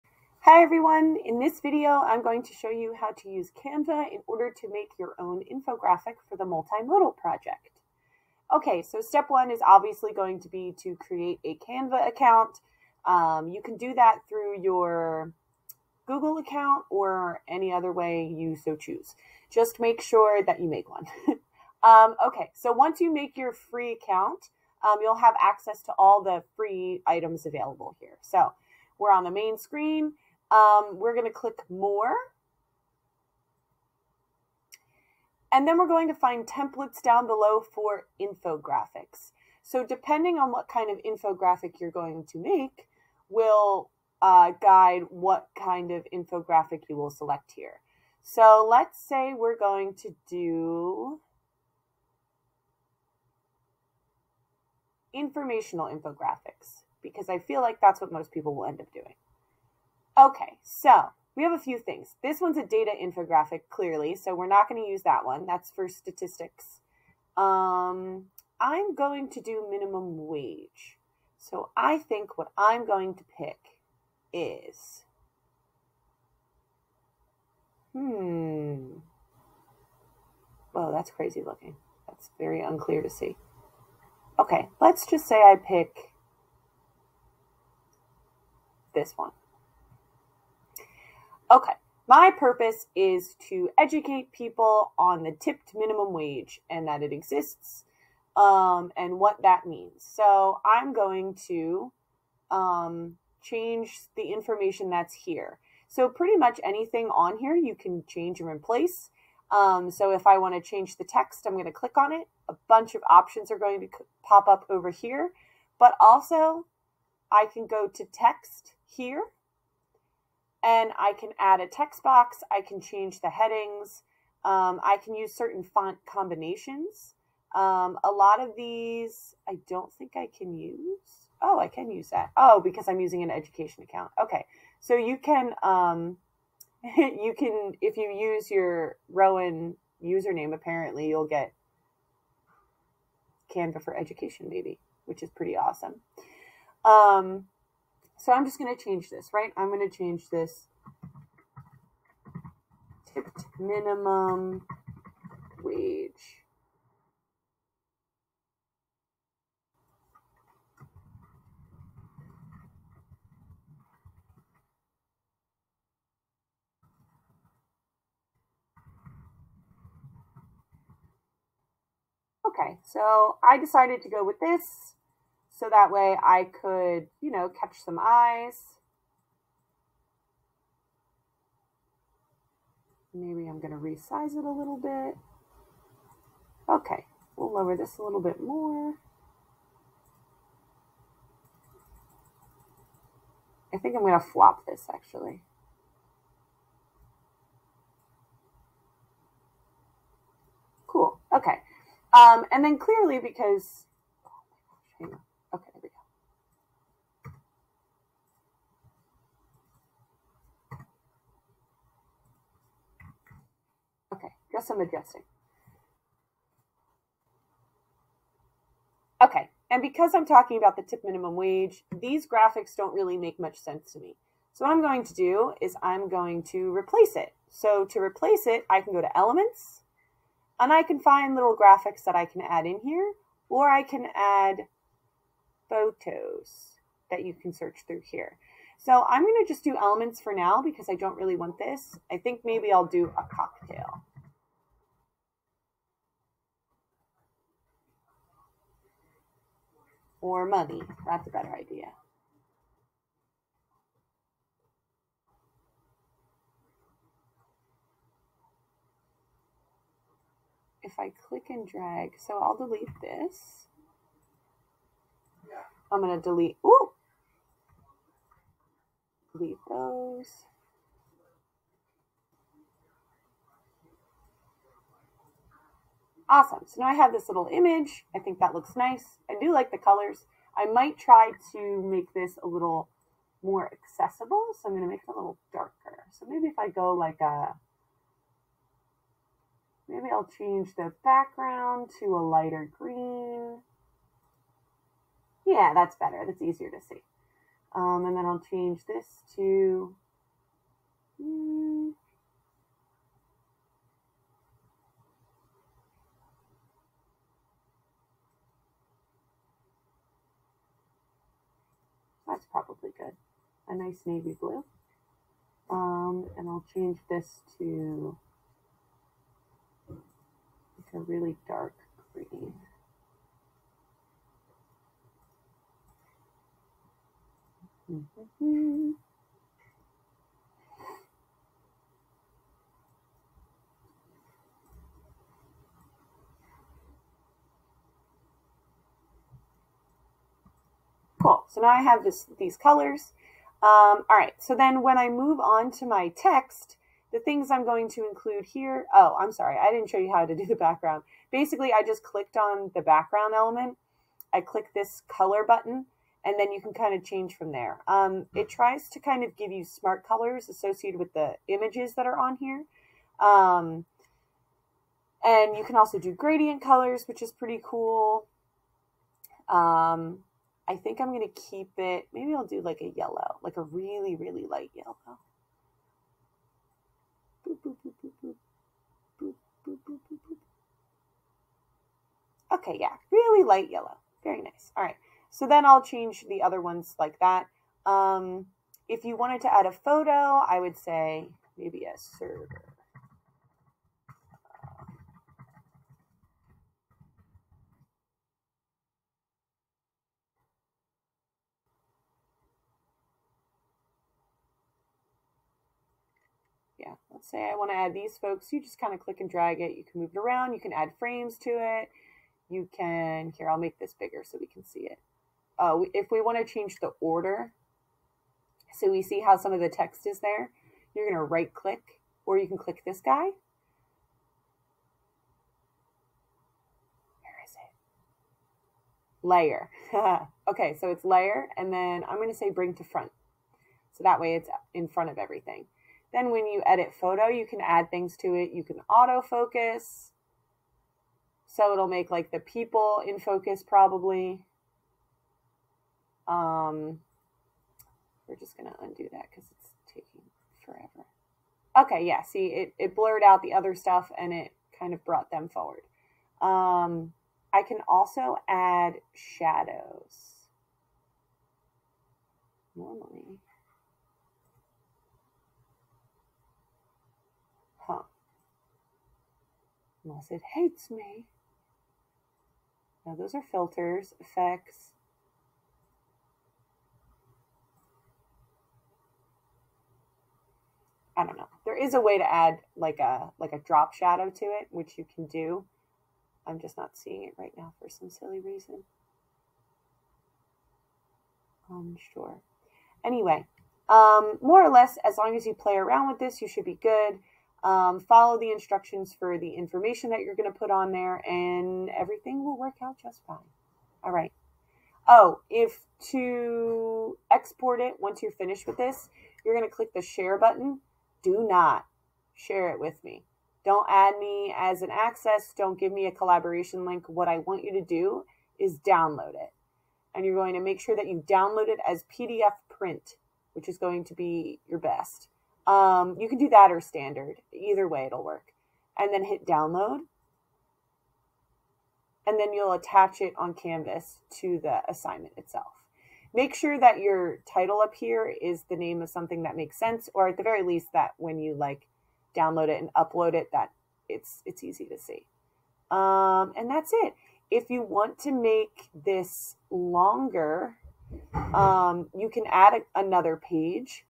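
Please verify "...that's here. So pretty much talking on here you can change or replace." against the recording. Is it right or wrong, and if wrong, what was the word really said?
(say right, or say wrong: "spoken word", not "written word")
wrong: "anything", not "talking".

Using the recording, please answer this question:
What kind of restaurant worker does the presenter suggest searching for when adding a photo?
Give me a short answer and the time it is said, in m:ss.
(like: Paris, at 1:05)
server, at 6:31.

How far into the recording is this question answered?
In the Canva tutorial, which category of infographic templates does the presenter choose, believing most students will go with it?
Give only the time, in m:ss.
0:55.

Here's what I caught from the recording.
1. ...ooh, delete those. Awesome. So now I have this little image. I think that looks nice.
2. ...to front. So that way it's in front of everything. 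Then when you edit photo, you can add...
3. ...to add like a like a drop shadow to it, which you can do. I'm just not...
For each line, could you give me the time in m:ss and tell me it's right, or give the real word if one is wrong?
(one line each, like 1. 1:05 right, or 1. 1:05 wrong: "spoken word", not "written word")
1. 4:26 right
2. 7:12 right
3. 8:02 right.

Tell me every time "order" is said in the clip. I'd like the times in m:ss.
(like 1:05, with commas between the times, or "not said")
0:04, 6:56.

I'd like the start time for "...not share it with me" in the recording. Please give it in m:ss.
8:31.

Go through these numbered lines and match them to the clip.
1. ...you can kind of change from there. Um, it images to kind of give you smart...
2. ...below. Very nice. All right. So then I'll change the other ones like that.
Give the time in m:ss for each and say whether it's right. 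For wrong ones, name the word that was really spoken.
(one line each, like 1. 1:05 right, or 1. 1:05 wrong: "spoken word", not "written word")
1. 5:56 wrong: "tries", not "images"
2. 6:23 wrong: "yellow", not "below".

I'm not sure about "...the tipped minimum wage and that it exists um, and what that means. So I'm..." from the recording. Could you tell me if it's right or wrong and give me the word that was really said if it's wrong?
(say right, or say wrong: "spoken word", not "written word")
right.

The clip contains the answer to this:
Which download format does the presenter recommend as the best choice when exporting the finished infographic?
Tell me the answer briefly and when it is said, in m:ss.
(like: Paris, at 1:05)
PDF print, at 8:42.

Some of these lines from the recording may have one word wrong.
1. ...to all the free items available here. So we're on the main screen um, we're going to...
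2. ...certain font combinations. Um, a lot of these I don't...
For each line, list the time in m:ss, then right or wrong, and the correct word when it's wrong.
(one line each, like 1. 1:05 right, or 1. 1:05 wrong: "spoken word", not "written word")
1. 0:25 right
2. 2:05 right.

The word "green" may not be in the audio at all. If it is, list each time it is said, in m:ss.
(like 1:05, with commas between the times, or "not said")
4:52, 5:22.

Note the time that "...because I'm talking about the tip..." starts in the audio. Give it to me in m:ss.
3:39.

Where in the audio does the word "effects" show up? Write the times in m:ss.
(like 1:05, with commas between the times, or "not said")
7:54.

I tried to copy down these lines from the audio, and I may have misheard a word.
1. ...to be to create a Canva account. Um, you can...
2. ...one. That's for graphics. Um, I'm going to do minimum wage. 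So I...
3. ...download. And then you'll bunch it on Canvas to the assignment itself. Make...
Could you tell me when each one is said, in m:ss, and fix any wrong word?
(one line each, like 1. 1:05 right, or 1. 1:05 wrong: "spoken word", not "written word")
1. 0:10 right
2. 1:05 wrong: "statistics", not "graphics"
3. 8:49 wrong: "attach", not "bunch".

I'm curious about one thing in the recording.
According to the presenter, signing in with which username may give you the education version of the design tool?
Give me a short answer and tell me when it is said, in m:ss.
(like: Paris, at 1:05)
Rowan username, at 2:19.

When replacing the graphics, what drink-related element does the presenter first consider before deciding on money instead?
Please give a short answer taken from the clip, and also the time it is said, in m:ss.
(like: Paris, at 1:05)
cocktail, at 4:03.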